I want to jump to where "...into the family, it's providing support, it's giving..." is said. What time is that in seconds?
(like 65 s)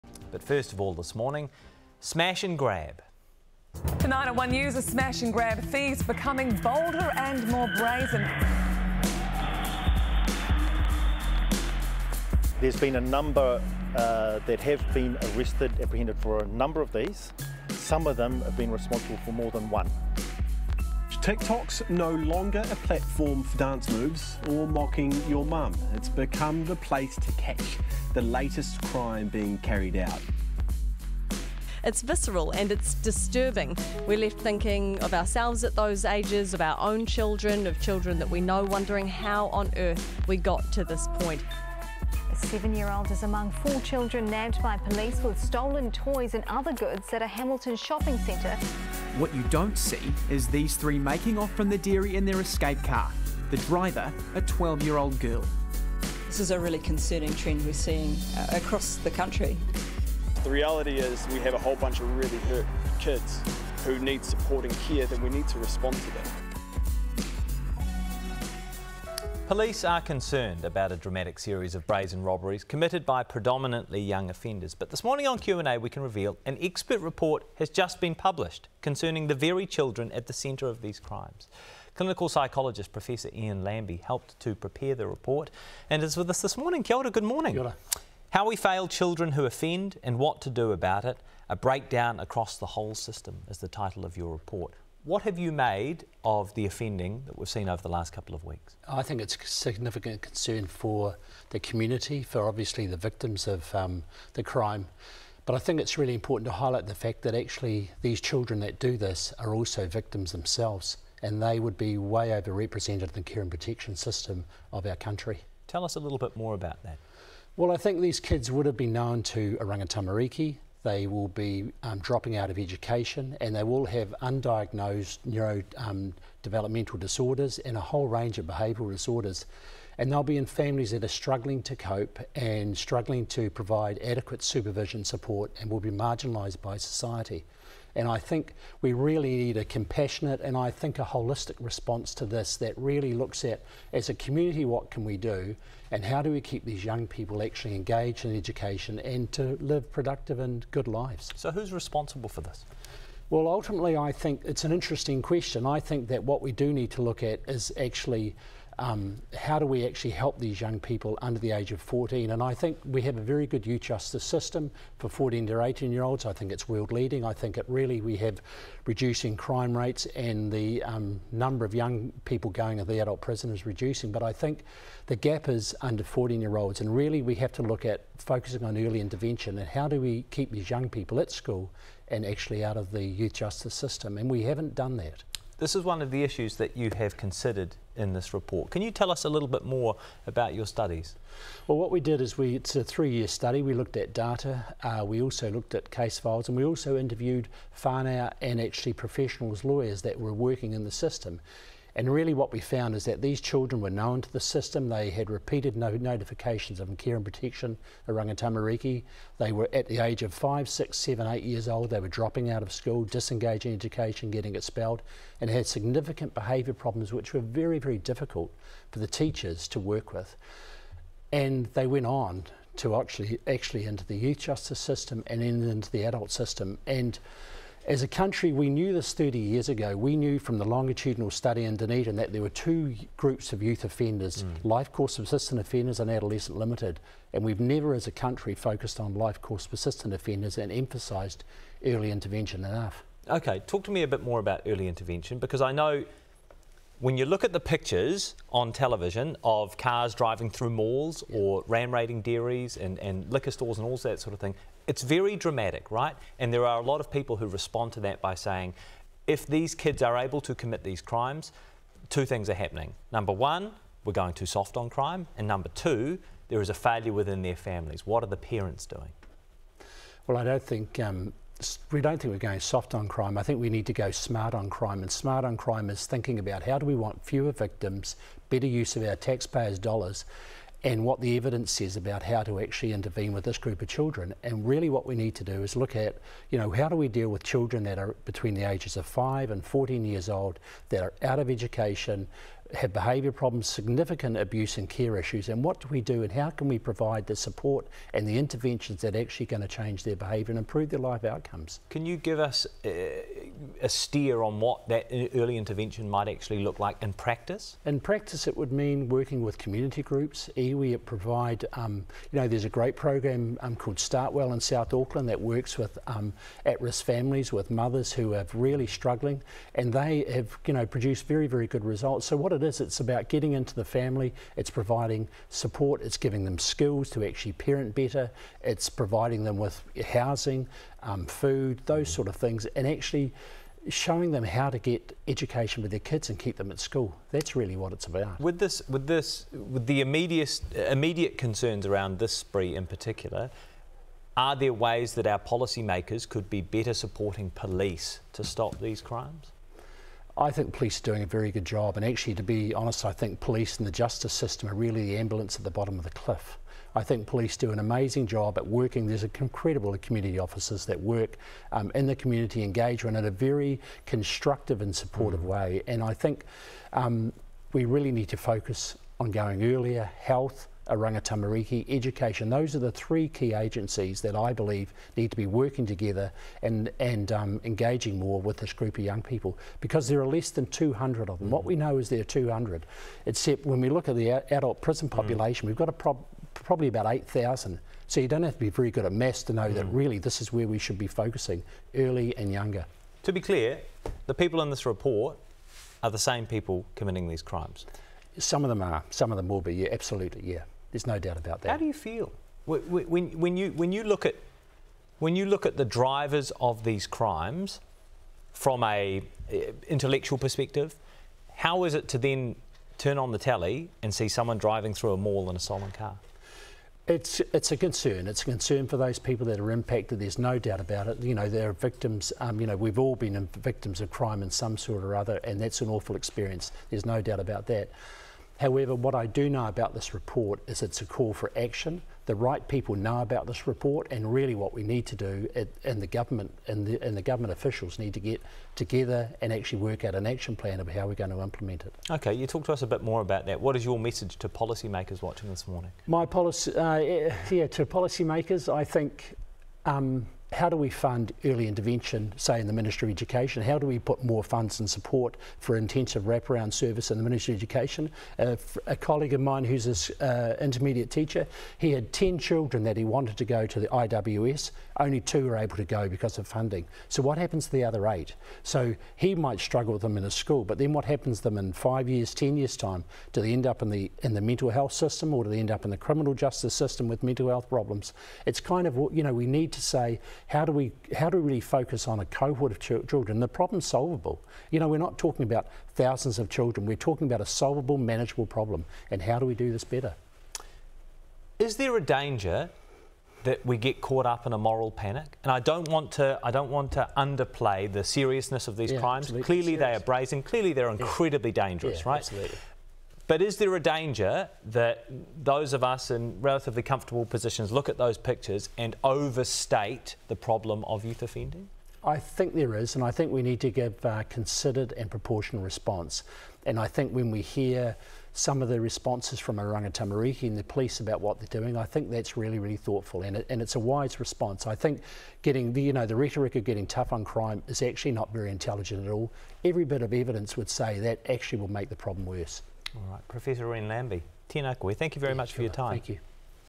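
323 s.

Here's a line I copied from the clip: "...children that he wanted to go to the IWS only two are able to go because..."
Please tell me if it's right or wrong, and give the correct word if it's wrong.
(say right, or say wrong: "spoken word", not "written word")
right.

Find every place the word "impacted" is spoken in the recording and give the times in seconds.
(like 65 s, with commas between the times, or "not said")
419 s.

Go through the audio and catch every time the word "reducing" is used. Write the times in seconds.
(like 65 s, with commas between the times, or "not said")
168 s, 173 s.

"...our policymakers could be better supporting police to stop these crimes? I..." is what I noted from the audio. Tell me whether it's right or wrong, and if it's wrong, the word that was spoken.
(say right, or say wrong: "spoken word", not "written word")
right.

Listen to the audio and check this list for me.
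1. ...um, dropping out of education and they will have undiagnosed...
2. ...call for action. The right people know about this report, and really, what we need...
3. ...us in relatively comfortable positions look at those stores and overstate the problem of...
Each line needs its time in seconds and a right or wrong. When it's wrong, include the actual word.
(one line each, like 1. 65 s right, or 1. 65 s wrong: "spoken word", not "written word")
1. 121 s right
2. 431 s right
3. 505 s wrong: "pictures", not "stores".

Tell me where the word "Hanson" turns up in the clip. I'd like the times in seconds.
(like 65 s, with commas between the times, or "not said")
not said.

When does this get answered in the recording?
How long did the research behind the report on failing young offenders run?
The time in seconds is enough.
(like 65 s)
192 s.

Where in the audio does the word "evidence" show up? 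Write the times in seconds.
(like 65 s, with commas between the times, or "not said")
281 s, 530 s.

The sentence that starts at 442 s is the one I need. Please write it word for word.
Okay, you talk to us a bit more about that.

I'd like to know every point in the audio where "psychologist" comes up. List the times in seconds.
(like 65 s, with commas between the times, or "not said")
82 s.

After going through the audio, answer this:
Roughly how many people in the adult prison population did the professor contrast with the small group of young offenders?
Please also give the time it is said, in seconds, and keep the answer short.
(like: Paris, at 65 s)
8,000, at 387 s.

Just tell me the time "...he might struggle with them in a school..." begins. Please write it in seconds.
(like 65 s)
469 s.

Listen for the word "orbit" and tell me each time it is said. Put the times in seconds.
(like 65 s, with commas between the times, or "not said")
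not said.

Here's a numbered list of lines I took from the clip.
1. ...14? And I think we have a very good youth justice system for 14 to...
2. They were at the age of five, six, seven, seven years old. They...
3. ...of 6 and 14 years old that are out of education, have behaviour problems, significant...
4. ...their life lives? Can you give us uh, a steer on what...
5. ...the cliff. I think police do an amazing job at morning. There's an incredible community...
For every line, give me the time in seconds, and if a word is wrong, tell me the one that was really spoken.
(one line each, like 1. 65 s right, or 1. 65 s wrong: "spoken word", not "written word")
1. 161 s right
2. 209 s wrong: "eight", not "seven"
3. 288 s wrong: "5", not "6"
4. 300 s wrong: "outcomes", not "lives"
5. 356 s wrong: "working", not "morning".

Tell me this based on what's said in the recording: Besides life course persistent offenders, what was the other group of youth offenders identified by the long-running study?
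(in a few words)
Adolescent limited.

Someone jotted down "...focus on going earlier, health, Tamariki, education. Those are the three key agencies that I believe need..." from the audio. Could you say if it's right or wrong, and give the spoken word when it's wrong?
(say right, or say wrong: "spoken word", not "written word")
right.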